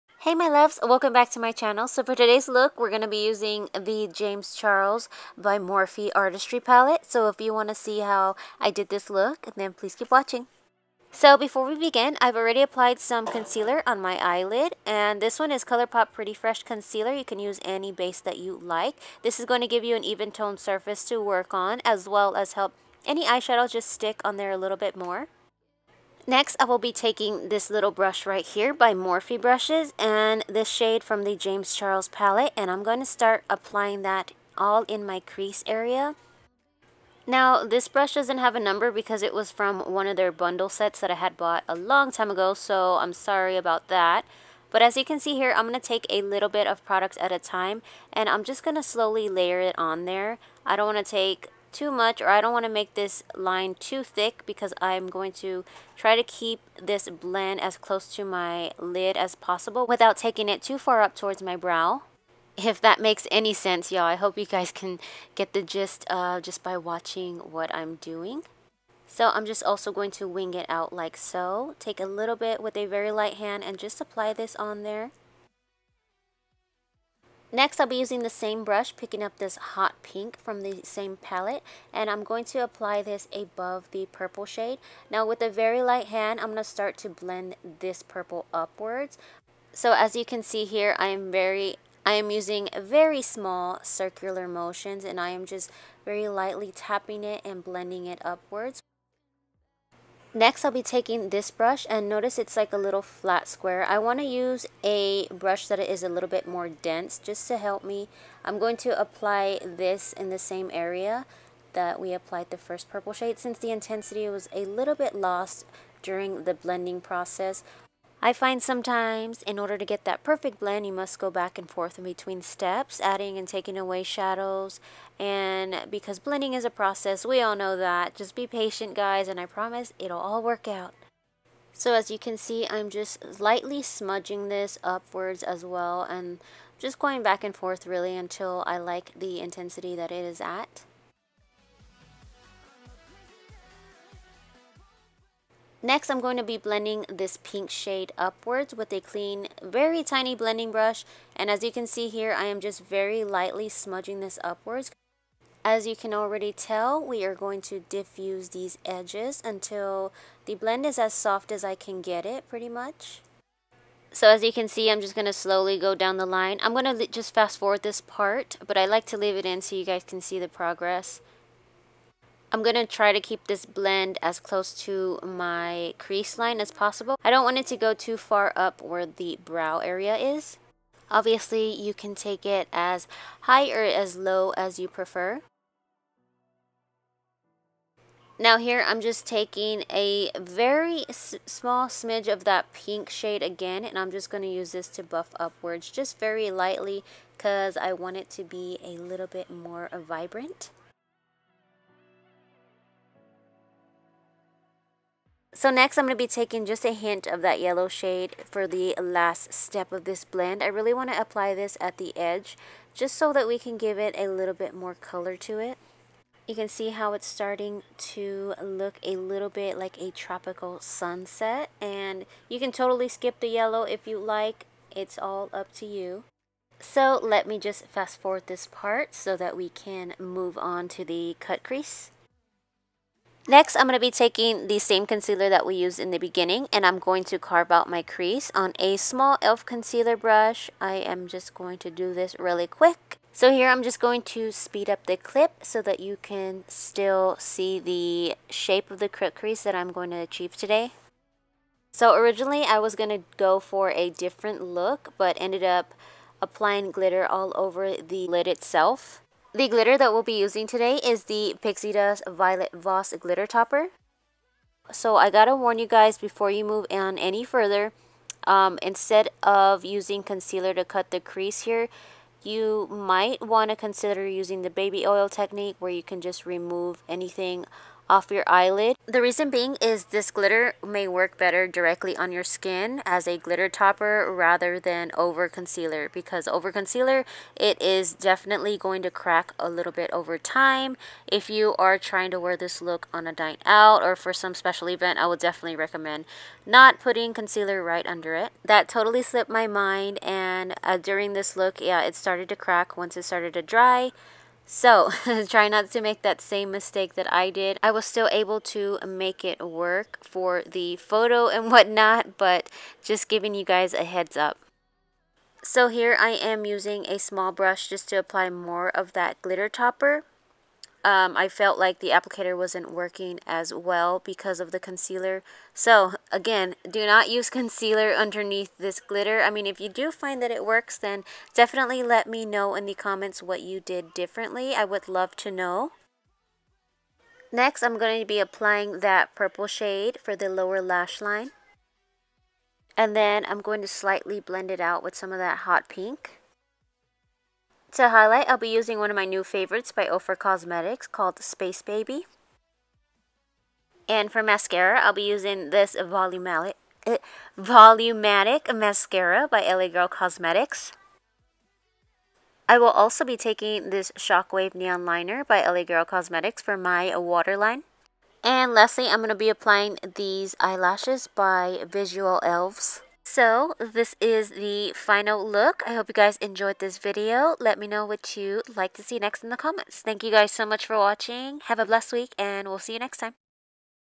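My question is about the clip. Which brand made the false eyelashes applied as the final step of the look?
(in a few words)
Visual Elves.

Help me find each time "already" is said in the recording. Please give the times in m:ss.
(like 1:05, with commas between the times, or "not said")
0:12, 2:36.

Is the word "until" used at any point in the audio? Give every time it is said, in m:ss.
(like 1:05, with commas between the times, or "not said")
2:18, 2:39.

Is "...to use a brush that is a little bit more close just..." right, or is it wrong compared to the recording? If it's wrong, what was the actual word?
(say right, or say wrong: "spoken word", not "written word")
wrong: "dense", not "close".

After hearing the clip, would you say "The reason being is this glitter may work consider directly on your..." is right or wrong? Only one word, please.
wrong.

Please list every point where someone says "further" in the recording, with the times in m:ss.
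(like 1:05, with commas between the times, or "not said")
4:27.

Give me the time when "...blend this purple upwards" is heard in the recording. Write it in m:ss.
1:27.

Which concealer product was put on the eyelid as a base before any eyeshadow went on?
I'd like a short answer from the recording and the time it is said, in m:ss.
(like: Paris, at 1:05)
ColourPop Pretty Fresh Concealer, at 0:15.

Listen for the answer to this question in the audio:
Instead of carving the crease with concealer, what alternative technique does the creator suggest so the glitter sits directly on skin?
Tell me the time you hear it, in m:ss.
4:34.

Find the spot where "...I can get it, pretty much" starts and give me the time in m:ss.
2:41.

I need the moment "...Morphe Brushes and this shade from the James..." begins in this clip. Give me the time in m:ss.
0:28.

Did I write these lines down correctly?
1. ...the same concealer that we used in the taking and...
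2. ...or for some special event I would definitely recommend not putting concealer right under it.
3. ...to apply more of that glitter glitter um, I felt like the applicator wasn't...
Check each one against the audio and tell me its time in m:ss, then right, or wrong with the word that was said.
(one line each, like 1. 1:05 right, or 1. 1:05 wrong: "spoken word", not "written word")
1. 3:54 wrong: "beginning", not "taking"
2. 4:54 right
3. 5:18 wrong: "topper", not "glitter".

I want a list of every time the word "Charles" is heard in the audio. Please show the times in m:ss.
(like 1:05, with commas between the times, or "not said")
0:04, 0:31.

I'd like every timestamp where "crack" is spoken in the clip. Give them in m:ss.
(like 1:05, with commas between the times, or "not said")
4:49, 5:02.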